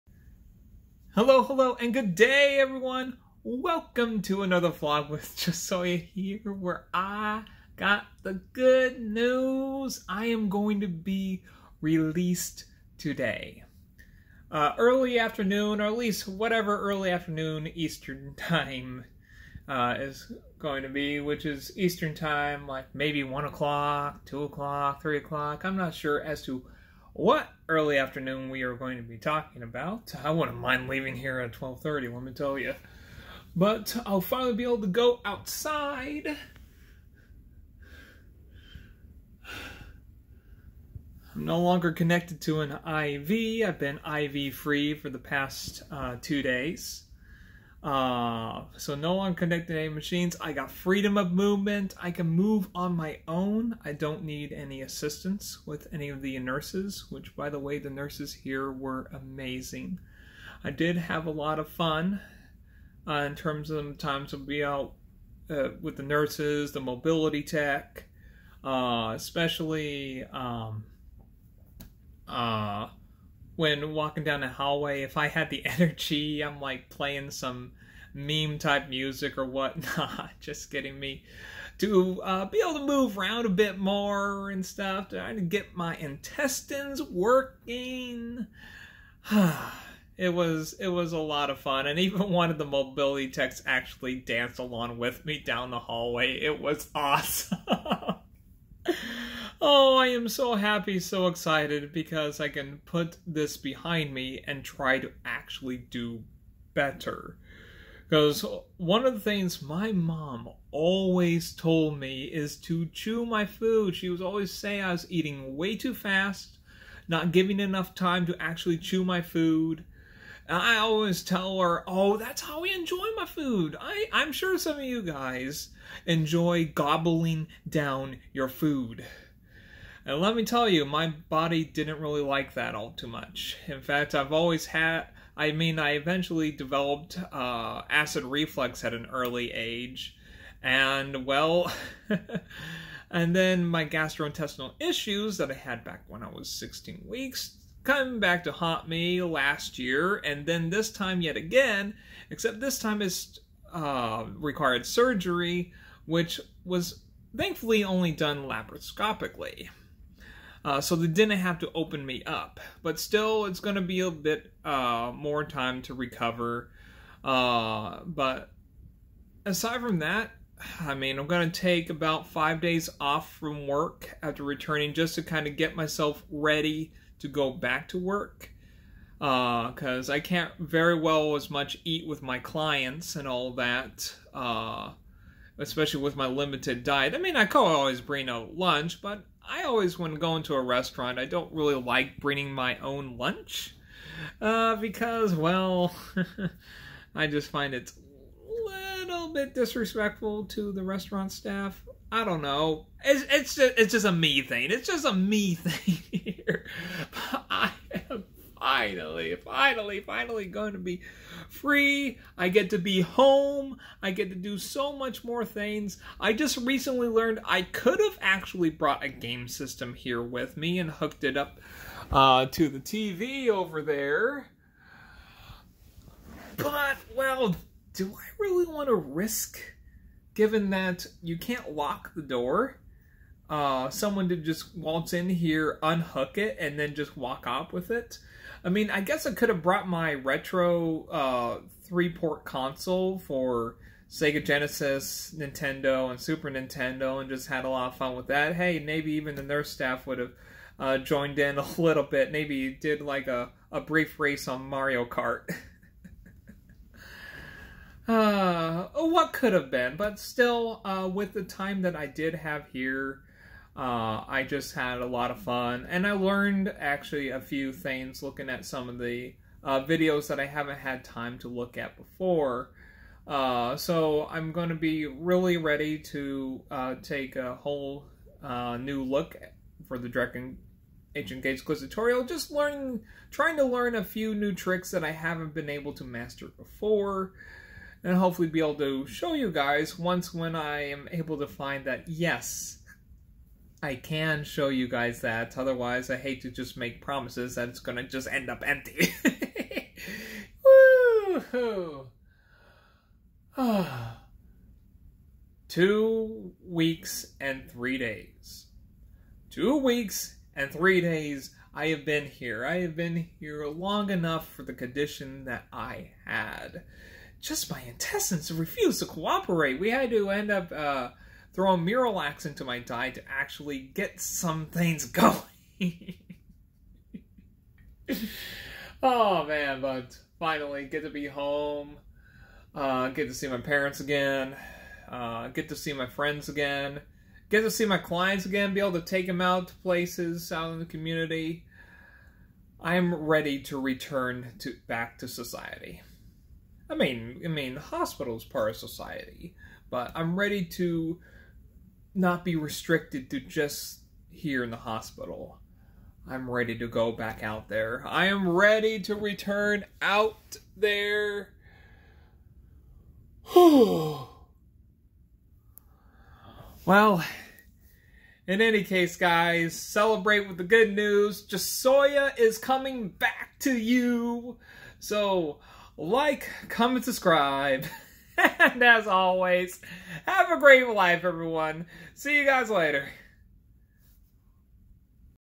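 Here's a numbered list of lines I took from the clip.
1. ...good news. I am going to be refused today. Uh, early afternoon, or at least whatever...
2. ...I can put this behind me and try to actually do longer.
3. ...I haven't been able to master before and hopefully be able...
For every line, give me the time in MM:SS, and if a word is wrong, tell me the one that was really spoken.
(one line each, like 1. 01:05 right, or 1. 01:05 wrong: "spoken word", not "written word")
1. 00:08 wrong: "released", not "refused"
2. 01:42 wrong: "better", not "longer"
3. 04:45 right.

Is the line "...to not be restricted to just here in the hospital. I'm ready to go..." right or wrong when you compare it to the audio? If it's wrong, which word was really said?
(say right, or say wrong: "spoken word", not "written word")
right.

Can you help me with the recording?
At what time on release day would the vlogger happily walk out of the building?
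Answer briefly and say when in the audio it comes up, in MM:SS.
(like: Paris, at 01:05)
12:30, at 00:31.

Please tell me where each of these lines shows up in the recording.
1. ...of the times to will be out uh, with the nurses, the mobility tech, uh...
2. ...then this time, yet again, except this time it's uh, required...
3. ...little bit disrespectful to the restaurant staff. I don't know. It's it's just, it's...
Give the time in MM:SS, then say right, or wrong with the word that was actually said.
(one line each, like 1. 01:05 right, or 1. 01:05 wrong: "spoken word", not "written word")
1. 01:03 right
2. 02:30 right
3. 03:18 right.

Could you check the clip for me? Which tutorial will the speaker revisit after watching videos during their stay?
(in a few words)
Dragon Ancient Gates Quiz.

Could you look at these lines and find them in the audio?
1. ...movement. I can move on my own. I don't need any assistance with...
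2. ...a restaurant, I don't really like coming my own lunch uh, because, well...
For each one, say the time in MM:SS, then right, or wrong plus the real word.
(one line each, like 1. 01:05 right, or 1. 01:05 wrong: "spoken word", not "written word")
1. 00:51 right
2. 03:10 wrong: "bringing", not "coming".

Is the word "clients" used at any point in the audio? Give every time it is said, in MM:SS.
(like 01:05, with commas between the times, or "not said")
03:02, 05:37.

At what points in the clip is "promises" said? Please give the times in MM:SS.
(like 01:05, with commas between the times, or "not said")
04:57.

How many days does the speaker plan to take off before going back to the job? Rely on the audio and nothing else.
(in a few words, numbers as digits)
5 days.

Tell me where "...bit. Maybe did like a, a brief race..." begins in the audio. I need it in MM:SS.
04:12.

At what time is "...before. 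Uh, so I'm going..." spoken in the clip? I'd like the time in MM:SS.
04:31.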